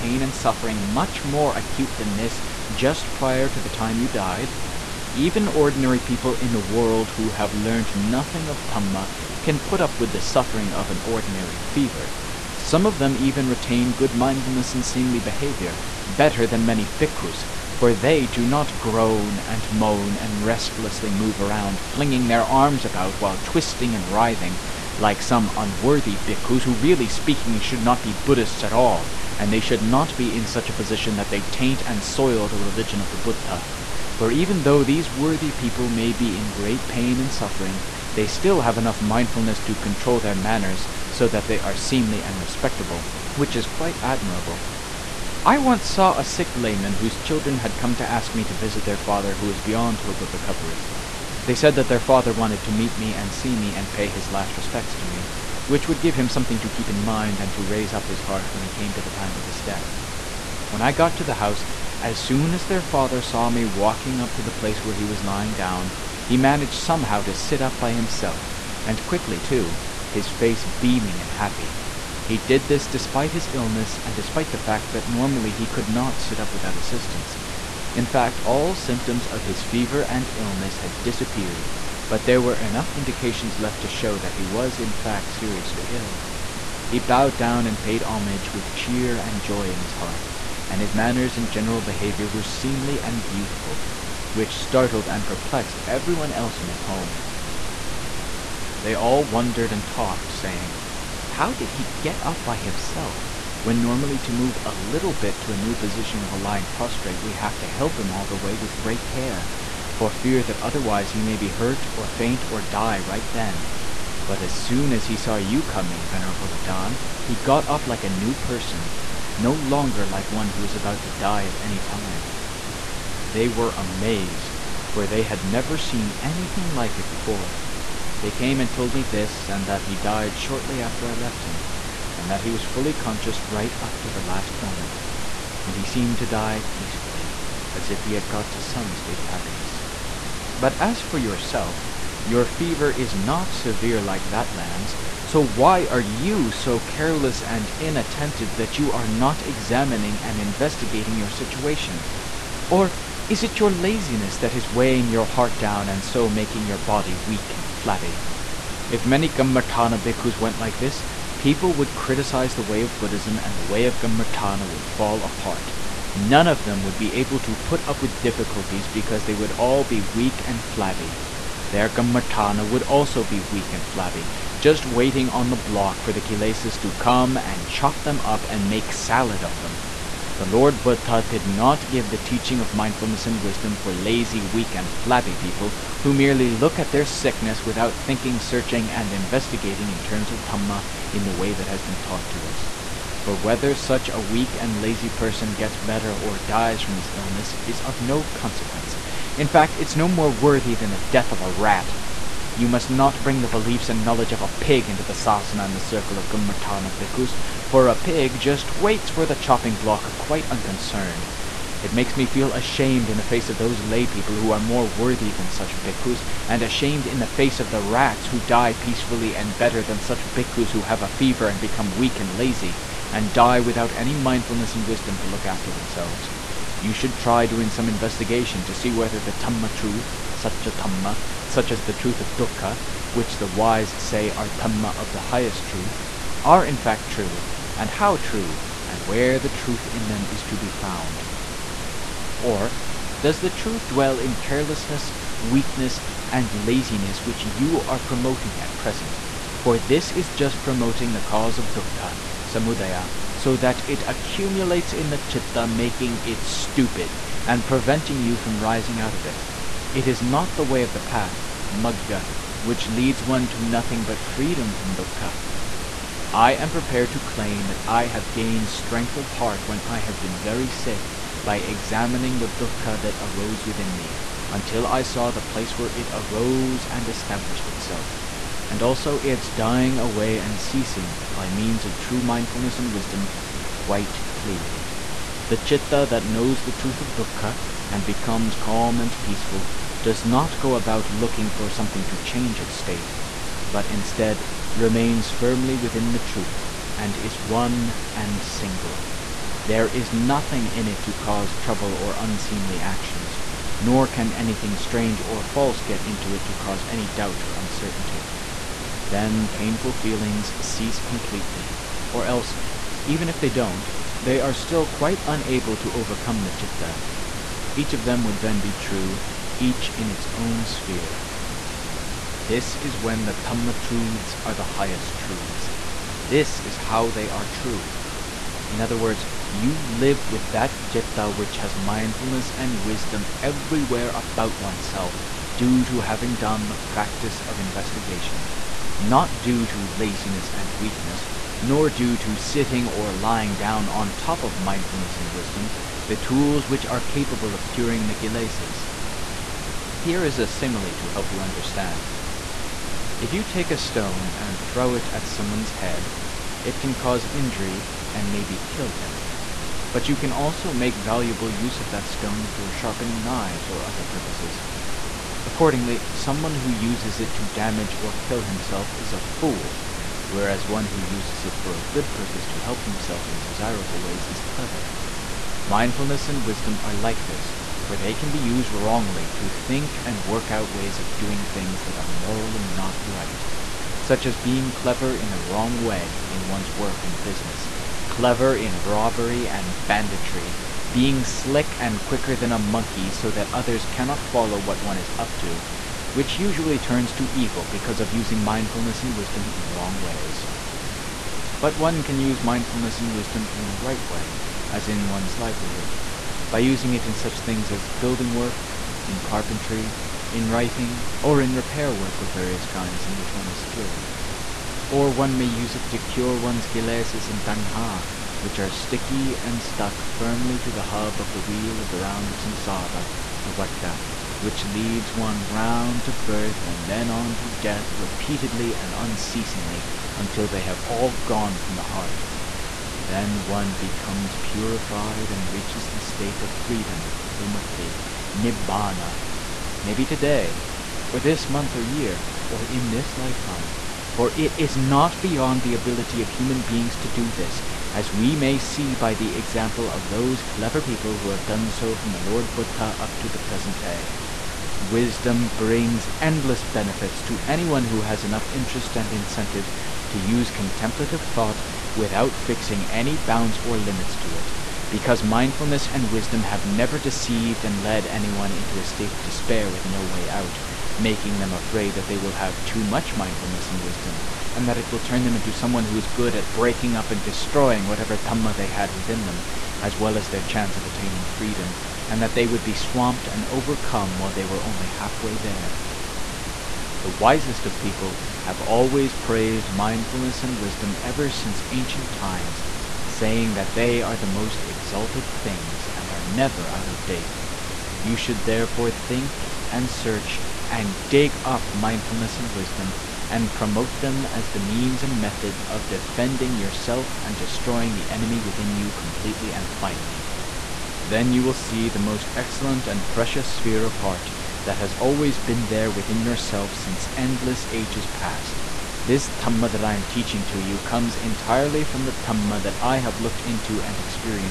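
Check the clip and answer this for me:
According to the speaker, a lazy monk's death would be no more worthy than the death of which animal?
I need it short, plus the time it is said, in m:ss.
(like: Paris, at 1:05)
A rat, at 3:21.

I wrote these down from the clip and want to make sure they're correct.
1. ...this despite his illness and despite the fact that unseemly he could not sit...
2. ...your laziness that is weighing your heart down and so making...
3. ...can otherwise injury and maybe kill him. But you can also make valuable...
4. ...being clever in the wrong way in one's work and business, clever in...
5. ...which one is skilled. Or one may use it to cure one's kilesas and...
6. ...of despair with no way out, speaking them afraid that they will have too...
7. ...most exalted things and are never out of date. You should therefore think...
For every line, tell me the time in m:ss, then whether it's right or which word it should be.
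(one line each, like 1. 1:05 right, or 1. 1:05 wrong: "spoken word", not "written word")
1. 1:12 wrong: "normally", not "unseemly"
2. 2:33 right
3. 5:56 wrong: "cause", not "otherwise"
4. 6:24 right
5. 6:53 right
6. 7:49 wrong: "making", not "speaking"
7. 8:14 right.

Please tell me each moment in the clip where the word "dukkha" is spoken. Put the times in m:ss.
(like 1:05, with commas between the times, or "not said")
3:52, 4:11, 4:24, 4:32, 4:47.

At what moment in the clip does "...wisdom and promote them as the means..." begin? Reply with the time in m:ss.
8:22.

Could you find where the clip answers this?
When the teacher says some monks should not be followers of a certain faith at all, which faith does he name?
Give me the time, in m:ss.
0:28.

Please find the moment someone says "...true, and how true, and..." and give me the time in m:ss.
3:57.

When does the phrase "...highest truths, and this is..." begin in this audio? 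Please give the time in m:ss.
5:24.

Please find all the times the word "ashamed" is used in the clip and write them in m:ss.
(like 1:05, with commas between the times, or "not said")
3:32, 3:36.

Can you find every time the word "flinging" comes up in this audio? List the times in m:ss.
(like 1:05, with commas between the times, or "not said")
0:21.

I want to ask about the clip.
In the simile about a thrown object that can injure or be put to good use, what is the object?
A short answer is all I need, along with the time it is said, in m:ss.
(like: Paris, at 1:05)
A stone, at 5:53.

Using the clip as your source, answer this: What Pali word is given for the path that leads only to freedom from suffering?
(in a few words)
magga.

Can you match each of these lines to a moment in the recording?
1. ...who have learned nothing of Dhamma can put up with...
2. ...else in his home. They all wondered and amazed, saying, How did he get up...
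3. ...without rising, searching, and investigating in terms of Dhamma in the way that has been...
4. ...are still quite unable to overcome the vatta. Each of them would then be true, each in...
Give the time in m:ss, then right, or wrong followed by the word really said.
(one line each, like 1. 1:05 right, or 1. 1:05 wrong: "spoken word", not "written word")
1. 0:07 right
2. 1:36 wrong: "talked", not "amazed"
3. 3:07 wrong: "thinking", not "rising"
4. 5:14 wrong: "citta", not "vatta".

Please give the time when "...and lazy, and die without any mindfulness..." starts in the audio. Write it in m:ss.
3:42.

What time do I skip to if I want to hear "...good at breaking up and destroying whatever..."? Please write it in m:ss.
7:56.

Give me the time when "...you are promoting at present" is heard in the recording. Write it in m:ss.
4:07.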